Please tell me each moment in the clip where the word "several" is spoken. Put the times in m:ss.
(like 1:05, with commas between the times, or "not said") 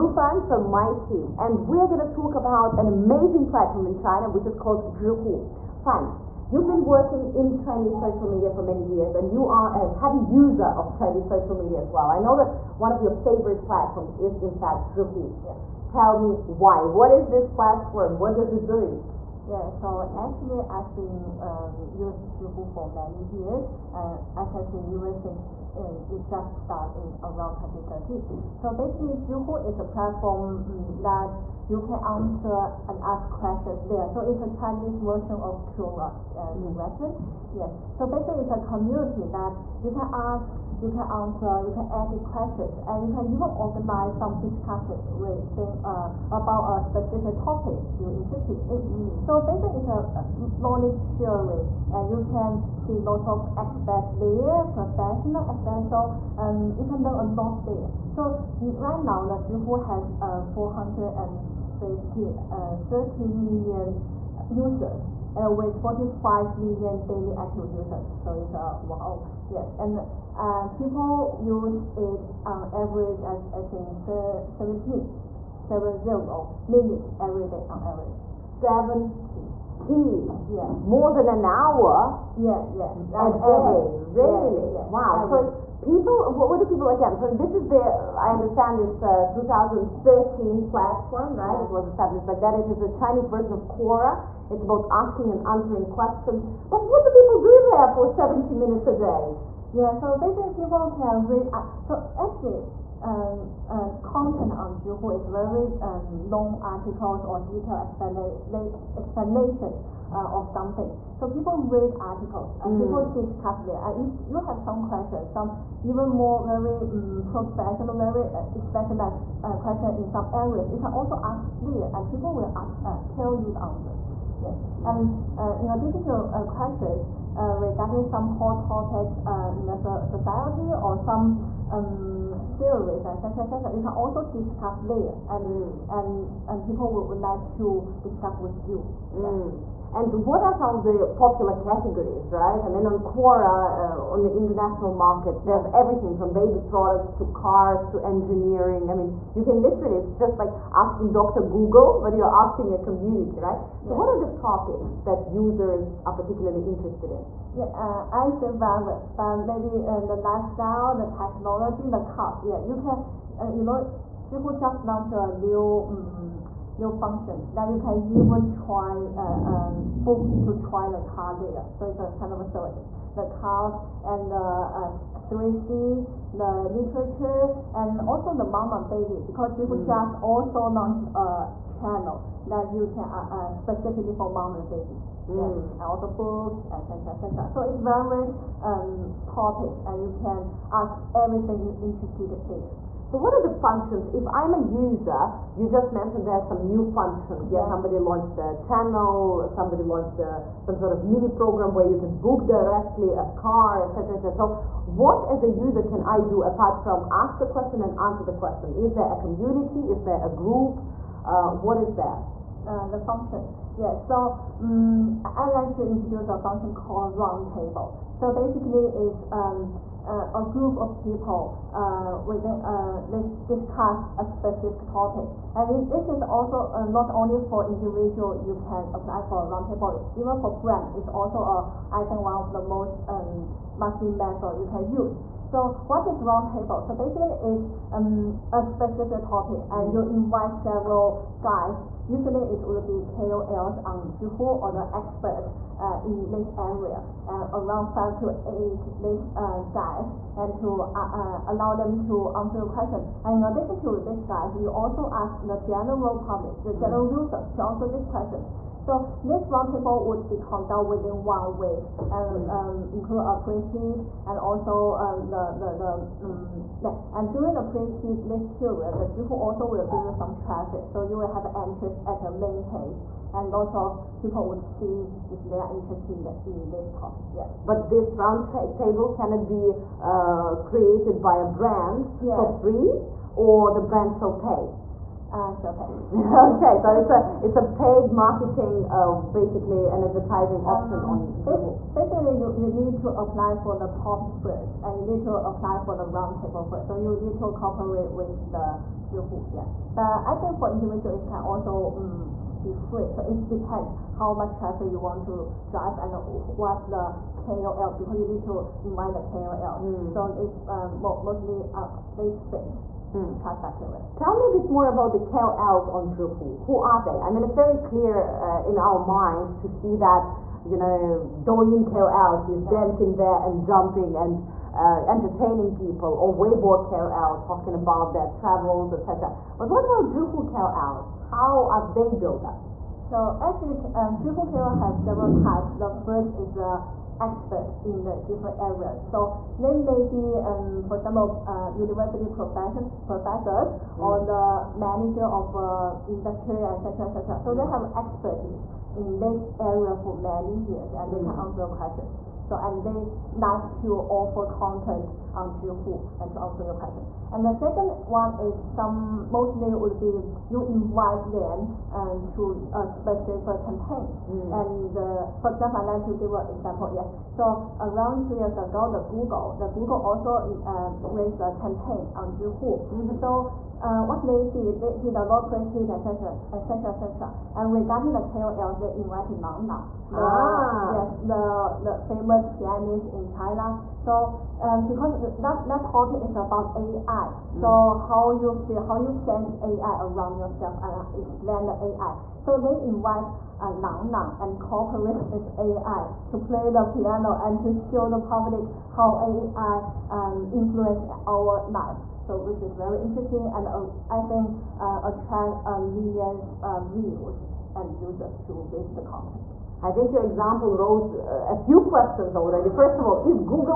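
4:00, 5:34.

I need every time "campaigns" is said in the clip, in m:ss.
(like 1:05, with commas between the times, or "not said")
6:03, 6:11.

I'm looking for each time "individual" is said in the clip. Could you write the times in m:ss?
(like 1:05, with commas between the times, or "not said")
3:47, 5:00.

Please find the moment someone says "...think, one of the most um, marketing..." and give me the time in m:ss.
3:52.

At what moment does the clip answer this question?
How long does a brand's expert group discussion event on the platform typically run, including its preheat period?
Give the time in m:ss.
4:21.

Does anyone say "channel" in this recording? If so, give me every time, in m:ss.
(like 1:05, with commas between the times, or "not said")
3:01, 3:18.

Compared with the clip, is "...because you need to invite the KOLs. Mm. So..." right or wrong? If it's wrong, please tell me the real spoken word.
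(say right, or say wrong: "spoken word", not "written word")
right.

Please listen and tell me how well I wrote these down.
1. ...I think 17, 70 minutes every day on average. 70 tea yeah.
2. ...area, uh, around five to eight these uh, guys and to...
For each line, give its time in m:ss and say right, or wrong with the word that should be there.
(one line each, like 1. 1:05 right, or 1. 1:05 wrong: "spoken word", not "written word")
1. 1:13 right
2. 4:06 right.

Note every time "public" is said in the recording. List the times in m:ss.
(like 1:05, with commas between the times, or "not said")
4:16, 6:38.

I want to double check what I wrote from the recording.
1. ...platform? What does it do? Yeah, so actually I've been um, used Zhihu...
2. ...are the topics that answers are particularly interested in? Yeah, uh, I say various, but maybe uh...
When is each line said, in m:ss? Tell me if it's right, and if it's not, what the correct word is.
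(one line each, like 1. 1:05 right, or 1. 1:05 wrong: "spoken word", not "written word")
1. 0:17 right
2. 2:34 wrong: "users", not "answers".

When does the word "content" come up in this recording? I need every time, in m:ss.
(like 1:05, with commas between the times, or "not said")
1:44, 5:54, 6:49.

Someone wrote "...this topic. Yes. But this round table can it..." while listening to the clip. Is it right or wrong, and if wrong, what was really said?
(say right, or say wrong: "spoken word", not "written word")
right.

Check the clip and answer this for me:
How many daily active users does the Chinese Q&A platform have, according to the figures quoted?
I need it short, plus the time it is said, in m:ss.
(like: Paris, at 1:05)
45 million, at 1:05.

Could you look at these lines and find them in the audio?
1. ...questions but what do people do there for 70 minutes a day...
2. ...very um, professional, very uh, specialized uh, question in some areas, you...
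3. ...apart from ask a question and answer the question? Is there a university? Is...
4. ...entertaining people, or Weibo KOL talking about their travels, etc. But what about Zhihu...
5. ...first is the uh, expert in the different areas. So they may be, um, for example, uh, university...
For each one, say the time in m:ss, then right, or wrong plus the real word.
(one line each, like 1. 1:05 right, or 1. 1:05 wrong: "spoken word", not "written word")
1. 1:35 right
2. 1:56 right
3. 3:26 wrong: "community", not "university"
4. 5:25 right
5. 5:36 right.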